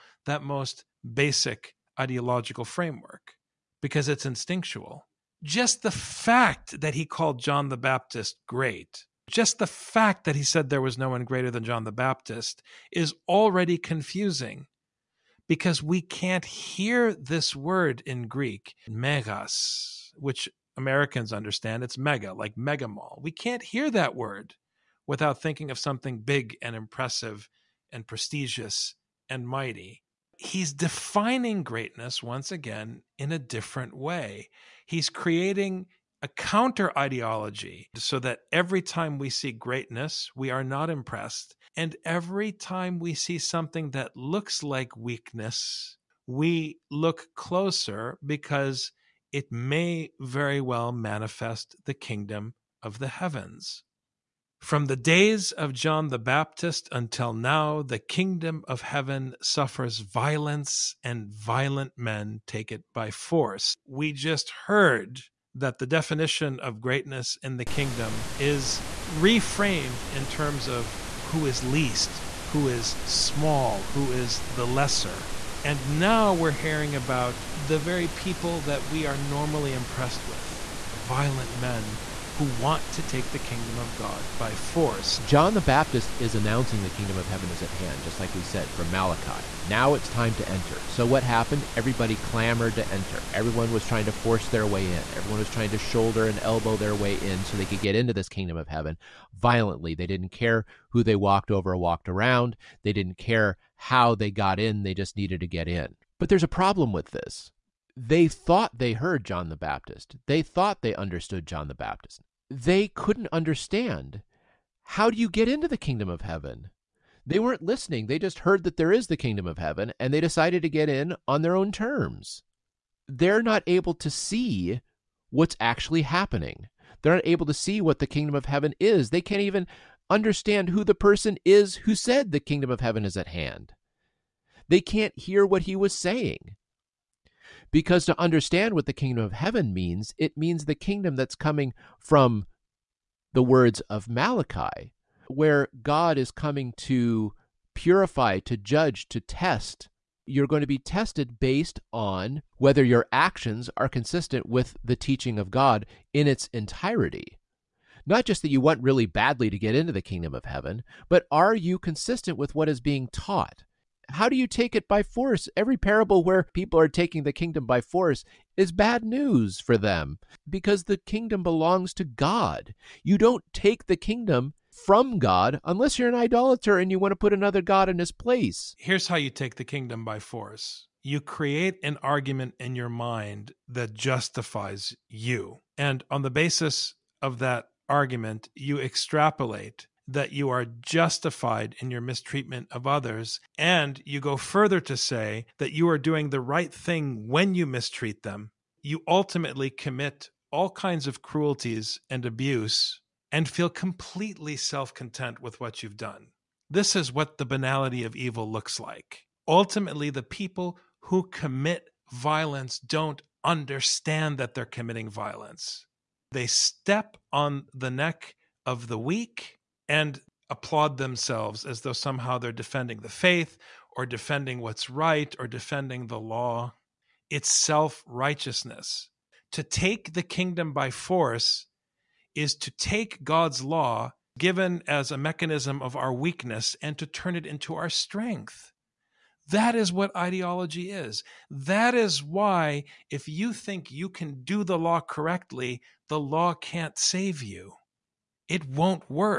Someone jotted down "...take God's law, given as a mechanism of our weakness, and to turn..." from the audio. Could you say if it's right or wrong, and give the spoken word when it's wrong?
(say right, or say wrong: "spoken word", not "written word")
right.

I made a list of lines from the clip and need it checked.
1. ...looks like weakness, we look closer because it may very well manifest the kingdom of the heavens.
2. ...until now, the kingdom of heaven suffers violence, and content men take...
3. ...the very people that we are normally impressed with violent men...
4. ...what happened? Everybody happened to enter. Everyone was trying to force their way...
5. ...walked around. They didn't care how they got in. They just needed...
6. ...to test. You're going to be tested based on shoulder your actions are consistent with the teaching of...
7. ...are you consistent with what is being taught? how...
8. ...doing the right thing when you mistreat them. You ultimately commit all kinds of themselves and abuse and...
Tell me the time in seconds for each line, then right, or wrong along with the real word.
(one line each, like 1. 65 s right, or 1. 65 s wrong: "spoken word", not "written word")
1. 44 s right
2. 56 s wrong: "violent", not "content"
3. 77 s right
4. 91 s wrong: "clamored", not "happened"
5. 101 s right
6. 149 s wrong: "whether", not "shoulder"
7. 161 s right
8. 195 s wrong: "cruelties", not "themselves".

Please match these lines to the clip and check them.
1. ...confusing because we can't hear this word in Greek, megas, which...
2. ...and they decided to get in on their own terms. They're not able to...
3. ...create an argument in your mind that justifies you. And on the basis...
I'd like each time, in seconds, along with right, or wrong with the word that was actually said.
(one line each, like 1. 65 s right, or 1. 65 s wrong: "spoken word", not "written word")
1. 13 s right
2. 120 s right
3. 181 s right.